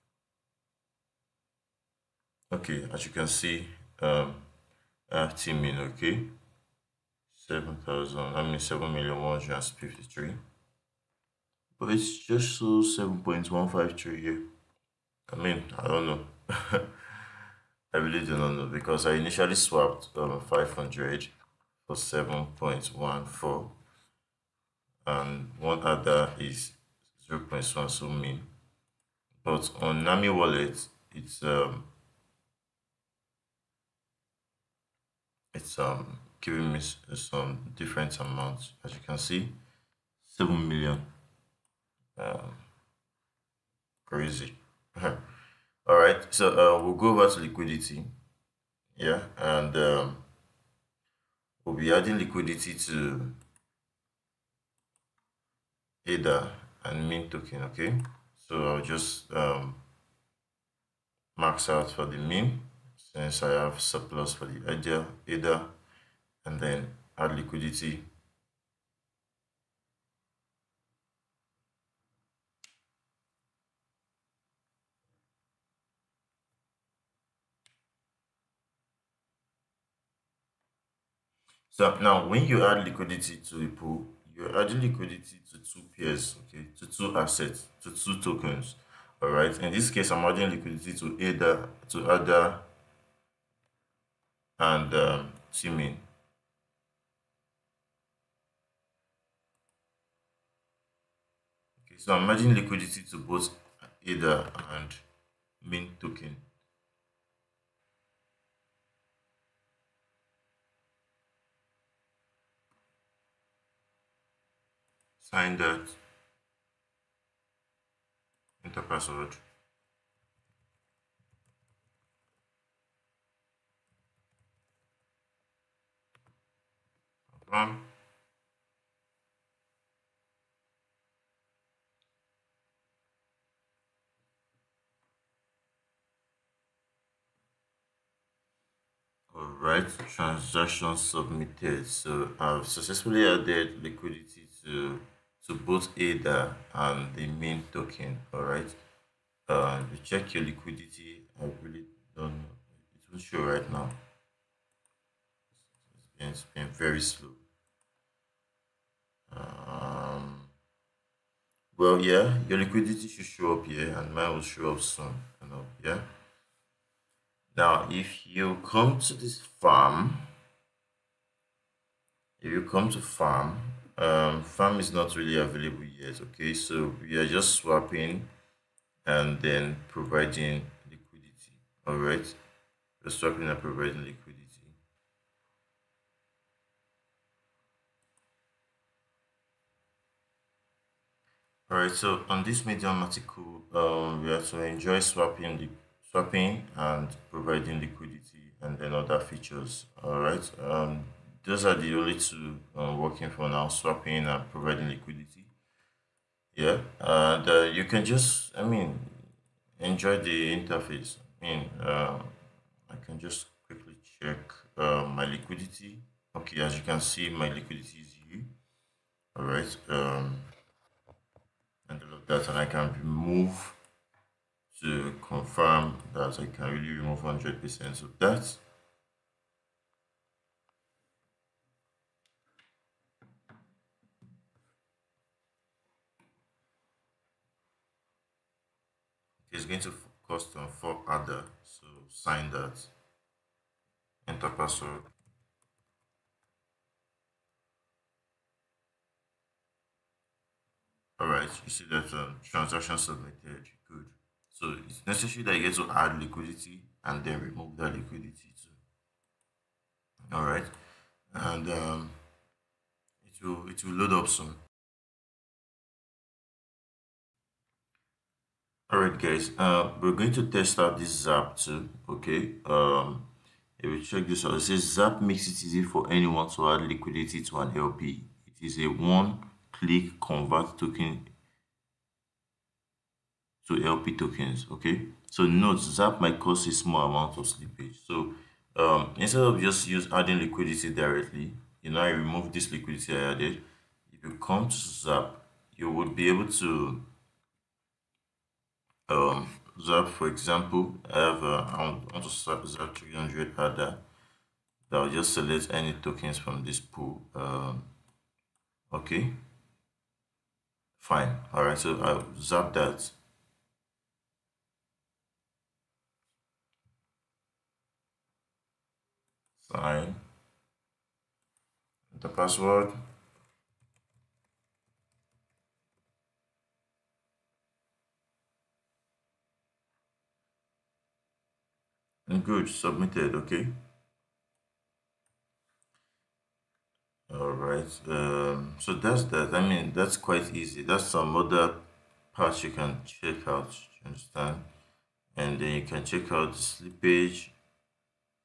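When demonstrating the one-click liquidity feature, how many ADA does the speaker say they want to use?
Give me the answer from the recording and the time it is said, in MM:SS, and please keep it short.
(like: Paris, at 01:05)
300 ADA, at 05:02.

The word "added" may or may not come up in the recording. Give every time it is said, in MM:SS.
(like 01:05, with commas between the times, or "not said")
02:23, 04:53.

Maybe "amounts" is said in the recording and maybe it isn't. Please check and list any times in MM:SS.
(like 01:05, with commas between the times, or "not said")
00:38, 04:47.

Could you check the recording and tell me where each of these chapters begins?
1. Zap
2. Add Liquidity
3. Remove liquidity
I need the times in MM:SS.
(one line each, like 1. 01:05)
1. 04:24
2. 00:46
3. 03:03.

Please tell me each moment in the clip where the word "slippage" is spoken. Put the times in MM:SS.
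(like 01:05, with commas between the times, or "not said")
04:47, 05:46.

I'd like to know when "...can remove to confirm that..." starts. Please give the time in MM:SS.
03:42.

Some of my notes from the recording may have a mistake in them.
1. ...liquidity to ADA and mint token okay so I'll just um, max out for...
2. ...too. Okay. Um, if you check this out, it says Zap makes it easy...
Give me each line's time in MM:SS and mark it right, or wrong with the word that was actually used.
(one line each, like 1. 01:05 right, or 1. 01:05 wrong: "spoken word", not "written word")
1. 00:52 right
2. 04:31 right.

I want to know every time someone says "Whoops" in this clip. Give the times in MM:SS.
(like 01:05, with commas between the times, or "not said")
not said.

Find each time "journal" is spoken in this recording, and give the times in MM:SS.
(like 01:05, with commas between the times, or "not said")
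not said.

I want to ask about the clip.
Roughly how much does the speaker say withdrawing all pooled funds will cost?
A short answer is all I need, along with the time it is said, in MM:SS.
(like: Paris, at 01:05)
4 ADA, at 04:00.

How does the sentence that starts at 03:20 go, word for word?
Alright, um, those are the only two uh, working for now, swapping and providing liquidity.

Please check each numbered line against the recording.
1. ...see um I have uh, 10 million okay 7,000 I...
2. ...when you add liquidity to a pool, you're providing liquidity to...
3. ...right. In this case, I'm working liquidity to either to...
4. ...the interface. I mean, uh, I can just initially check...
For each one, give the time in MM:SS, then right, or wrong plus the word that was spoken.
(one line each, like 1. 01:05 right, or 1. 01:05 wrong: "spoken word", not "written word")
1. 00:03 right
2. 01:22 wrong: "adding", not "providing"
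3. 01:29 wrong: "adding", not "working"
4. 03:30 wrong: "quickly", not "initially".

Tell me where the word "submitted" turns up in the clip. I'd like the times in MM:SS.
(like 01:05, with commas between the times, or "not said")
02:20, 04:12, 05:32.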